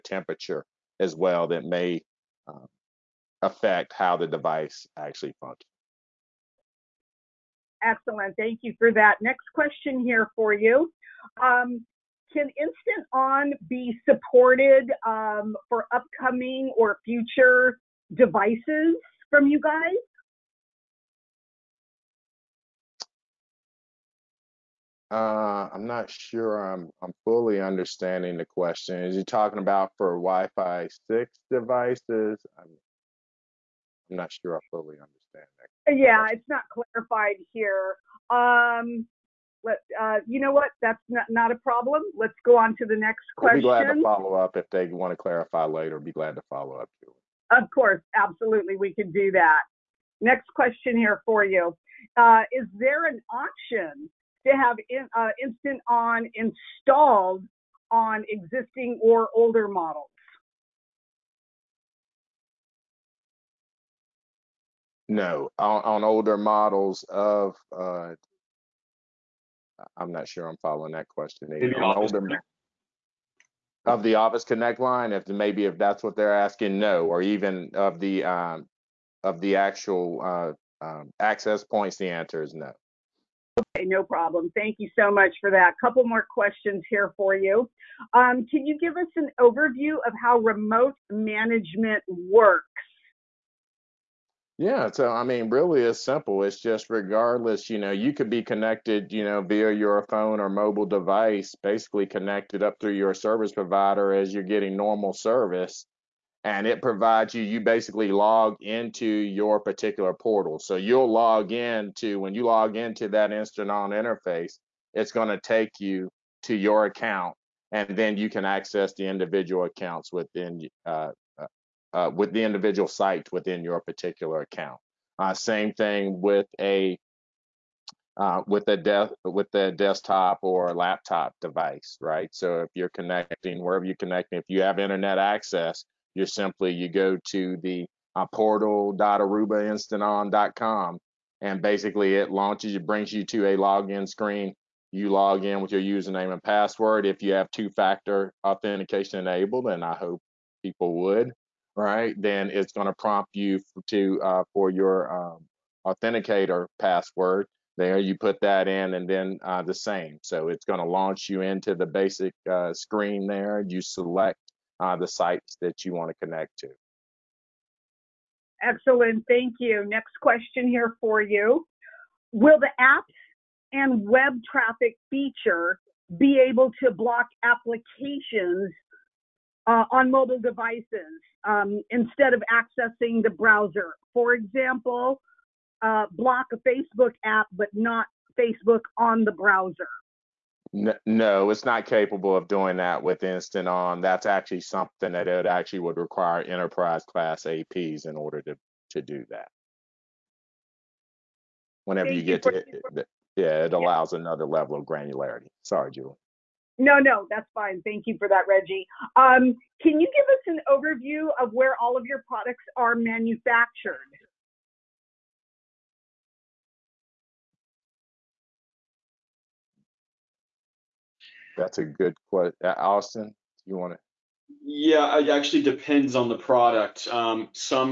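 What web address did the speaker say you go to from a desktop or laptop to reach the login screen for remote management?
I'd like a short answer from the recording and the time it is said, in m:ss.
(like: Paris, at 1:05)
portal.arubainstanton.com, at 2:18.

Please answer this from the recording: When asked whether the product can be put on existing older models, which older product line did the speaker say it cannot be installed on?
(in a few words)
OfficeConnect.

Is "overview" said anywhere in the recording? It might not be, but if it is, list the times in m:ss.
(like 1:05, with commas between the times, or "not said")
1:29, 3:30.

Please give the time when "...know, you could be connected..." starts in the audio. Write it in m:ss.
1:37.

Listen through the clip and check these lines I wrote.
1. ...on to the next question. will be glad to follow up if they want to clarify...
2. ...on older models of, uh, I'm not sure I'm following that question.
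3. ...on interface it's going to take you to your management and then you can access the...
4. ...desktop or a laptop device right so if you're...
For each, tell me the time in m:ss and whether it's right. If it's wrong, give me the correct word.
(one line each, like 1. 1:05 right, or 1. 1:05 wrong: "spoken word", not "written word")
1. 0:42 right
2. 1:05 right
3. 1:53 wrong: "account", not "management"
4. 2:09 right.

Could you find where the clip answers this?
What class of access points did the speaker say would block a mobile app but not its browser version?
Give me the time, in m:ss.
3:16.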